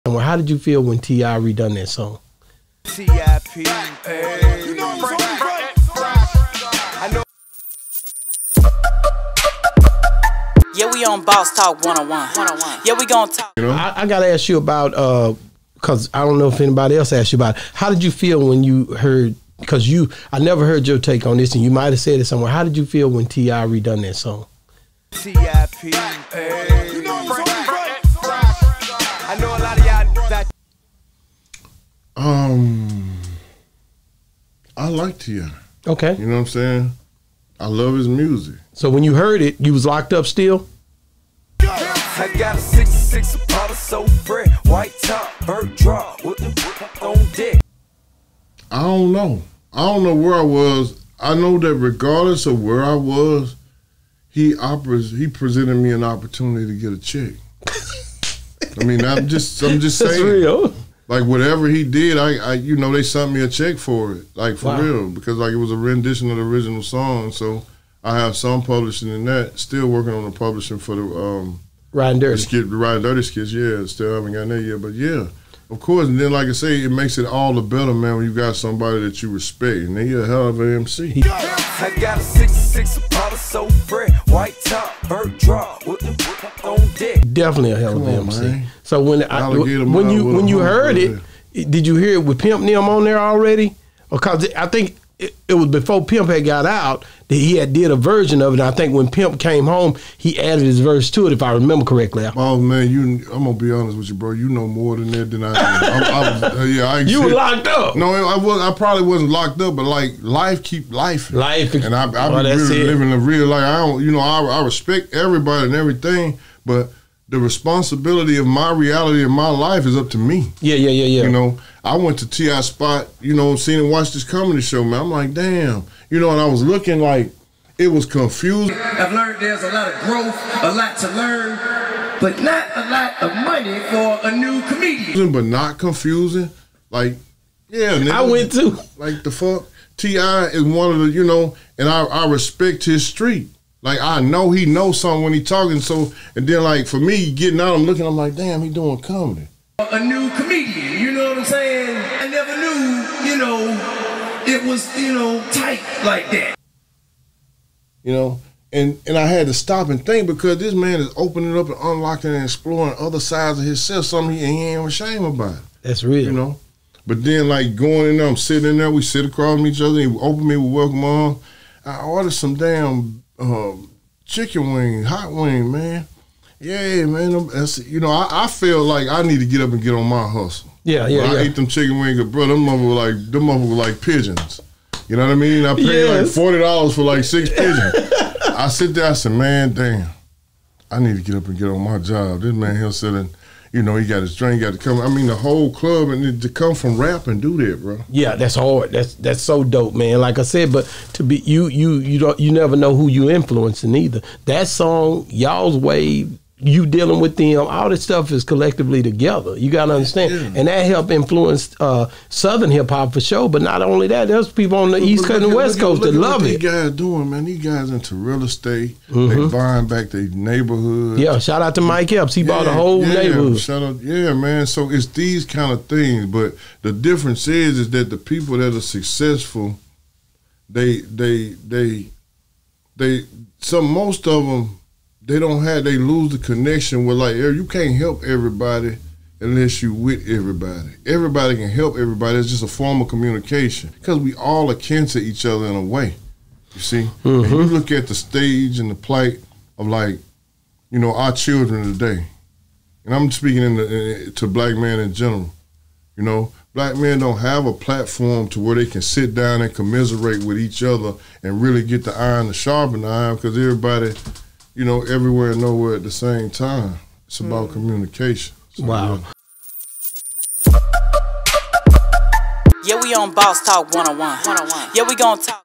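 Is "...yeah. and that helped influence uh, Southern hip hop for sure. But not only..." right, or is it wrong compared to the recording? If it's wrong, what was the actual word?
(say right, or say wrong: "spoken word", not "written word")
right.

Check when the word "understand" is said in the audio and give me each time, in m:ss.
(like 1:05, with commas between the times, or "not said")
3:29.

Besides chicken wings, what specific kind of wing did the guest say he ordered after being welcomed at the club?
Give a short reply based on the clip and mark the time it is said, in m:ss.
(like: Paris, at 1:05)
Hot wing, at 2:55.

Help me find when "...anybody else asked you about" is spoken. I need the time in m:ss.
0:16.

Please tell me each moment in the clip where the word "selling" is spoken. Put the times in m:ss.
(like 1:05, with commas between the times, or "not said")
3:12.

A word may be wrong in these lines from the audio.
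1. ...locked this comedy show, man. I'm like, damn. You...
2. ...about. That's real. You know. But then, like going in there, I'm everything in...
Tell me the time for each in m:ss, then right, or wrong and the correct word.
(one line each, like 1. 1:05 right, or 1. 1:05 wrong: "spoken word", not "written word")
1. 2:03 wrong: "watched", not "locked"
2. 2:45 wrong: "sitting", not "everything".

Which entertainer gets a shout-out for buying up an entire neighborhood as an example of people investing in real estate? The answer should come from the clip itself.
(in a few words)
Mike Epps.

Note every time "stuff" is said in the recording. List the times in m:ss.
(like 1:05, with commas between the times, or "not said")
3:28.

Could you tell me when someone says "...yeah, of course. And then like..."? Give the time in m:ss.
1:14.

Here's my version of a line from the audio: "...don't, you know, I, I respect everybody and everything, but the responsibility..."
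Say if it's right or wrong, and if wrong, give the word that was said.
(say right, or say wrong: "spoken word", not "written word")
right.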